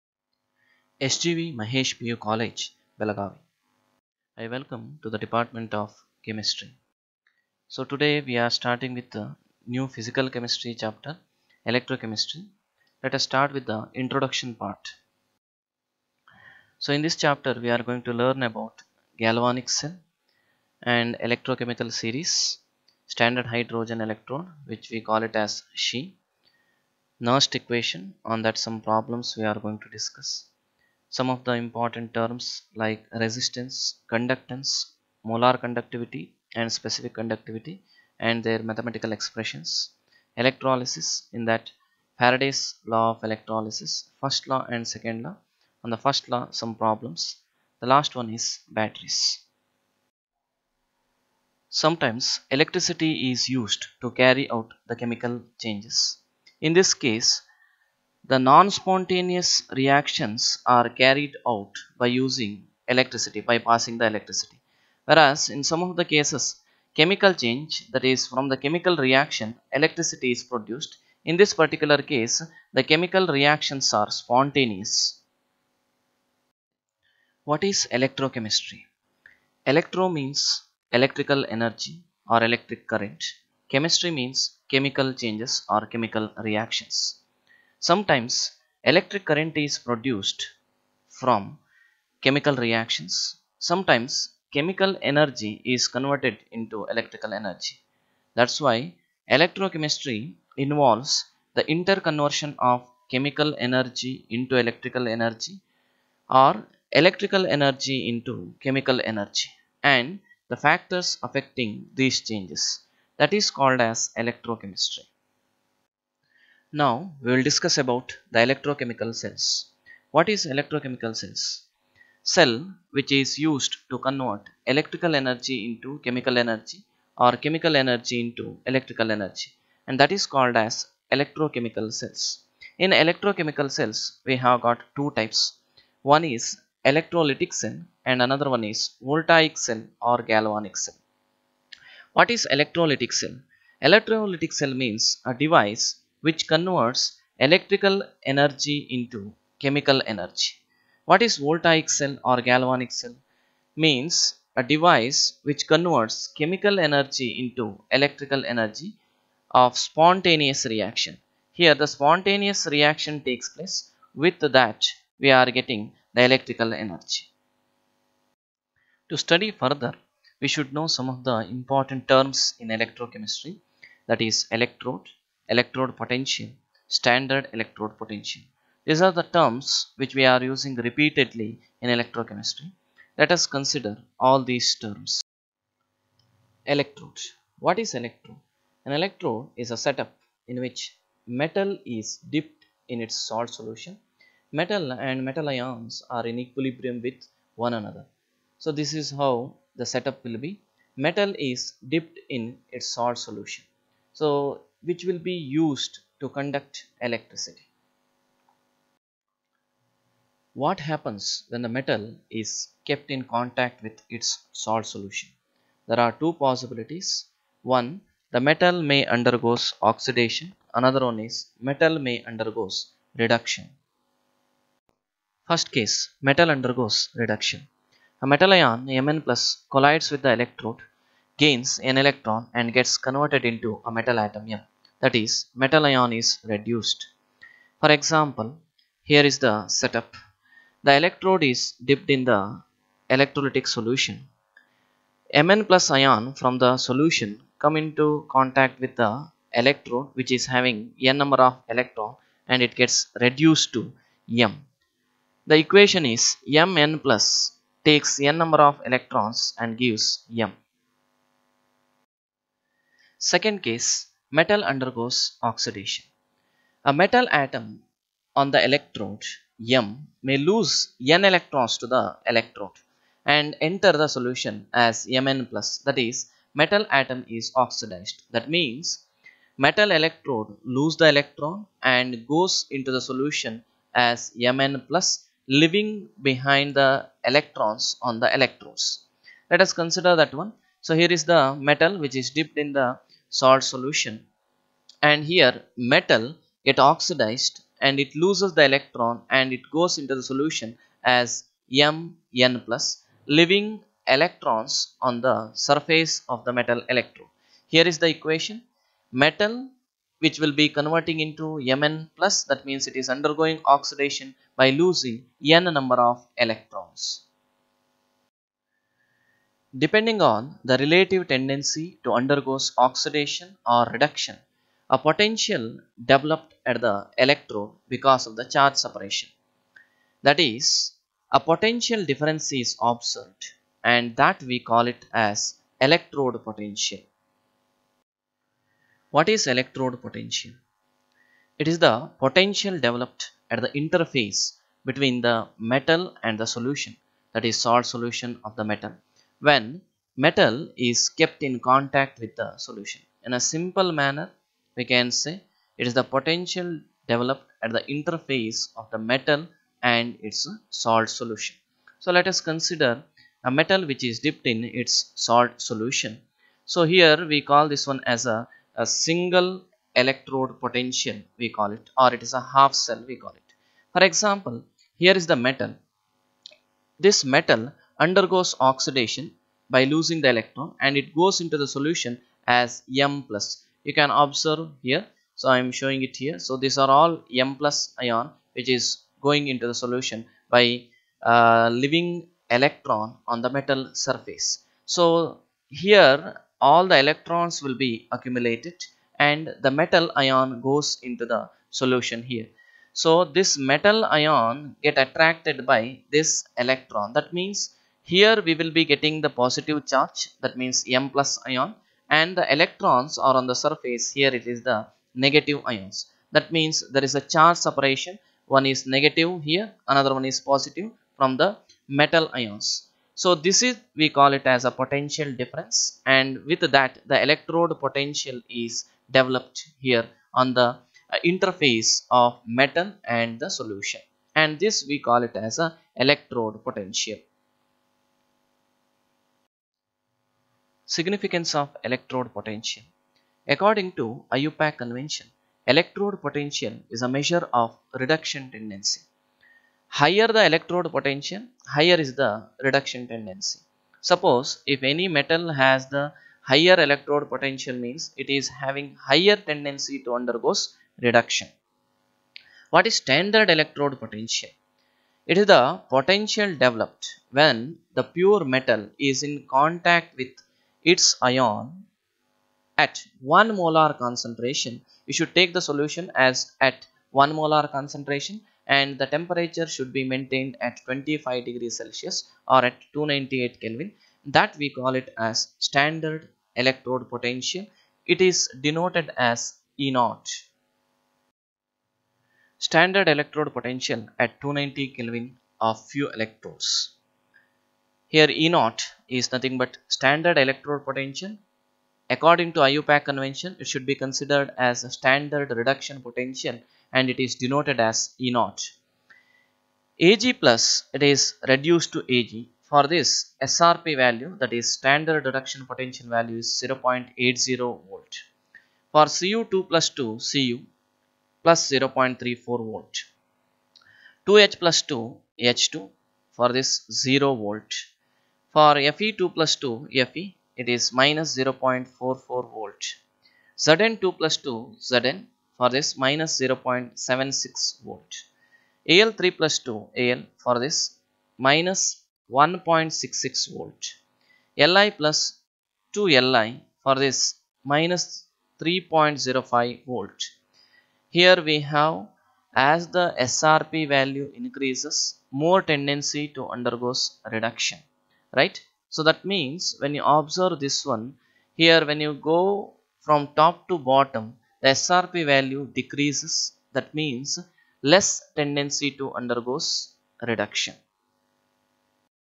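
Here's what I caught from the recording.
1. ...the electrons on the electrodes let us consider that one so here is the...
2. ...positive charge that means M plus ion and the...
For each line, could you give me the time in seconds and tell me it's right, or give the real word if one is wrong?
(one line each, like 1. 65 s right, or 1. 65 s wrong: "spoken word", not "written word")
1. 286 s right
2. 409 s right.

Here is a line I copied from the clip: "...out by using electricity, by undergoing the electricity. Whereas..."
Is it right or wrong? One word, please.
wrong.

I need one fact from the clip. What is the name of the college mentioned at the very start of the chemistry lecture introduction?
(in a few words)
SGV Mahesh PU College.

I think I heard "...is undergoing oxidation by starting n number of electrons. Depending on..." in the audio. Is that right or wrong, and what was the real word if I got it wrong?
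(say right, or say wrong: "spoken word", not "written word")
wrong: "losing", not "starting".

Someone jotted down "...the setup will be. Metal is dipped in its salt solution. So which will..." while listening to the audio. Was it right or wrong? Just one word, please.
right.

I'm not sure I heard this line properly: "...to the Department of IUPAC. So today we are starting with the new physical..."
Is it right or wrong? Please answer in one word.
wrong.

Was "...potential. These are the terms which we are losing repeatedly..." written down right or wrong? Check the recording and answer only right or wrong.
wrong.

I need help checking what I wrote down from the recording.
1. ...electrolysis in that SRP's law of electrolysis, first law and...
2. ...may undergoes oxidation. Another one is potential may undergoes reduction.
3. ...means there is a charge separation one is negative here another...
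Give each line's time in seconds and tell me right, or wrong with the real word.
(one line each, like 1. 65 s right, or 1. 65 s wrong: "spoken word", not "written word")
1. 40 s wrong: "Faraday", not "SRP"
2. 218 s wrong: "metal", not "potential"
3. 416 s right.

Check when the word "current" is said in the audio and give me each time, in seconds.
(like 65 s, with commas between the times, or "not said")
82 s, 89 s.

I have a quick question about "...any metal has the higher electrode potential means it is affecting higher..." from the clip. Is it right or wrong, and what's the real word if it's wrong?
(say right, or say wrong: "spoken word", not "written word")
wrong: "having", not "affecting".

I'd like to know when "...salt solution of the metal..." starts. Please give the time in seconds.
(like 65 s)
347 s.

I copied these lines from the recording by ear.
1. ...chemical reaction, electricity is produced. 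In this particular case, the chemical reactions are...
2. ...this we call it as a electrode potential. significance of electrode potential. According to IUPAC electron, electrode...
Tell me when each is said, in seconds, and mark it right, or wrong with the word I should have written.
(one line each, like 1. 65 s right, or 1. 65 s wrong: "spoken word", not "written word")
1. 68 s right
2. 434 s wrong: "convention", not "electron".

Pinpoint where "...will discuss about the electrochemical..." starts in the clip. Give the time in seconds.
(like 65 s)
117 s.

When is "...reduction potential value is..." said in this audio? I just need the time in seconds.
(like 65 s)
515 s.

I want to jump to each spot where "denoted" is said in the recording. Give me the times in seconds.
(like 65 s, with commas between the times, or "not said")
488 s, 507 s.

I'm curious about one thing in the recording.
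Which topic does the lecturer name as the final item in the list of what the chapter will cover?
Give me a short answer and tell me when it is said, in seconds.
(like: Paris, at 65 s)
batteries, at 48 s.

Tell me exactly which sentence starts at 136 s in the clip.
One is electrolytic cell and another one is voltaic cell or galvanic cell.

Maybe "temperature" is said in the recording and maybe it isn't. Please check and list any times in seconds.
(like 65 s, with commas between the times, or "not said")
479 s.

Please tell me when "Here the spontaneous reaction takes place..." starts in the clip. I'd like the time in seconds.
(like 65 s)
161 s.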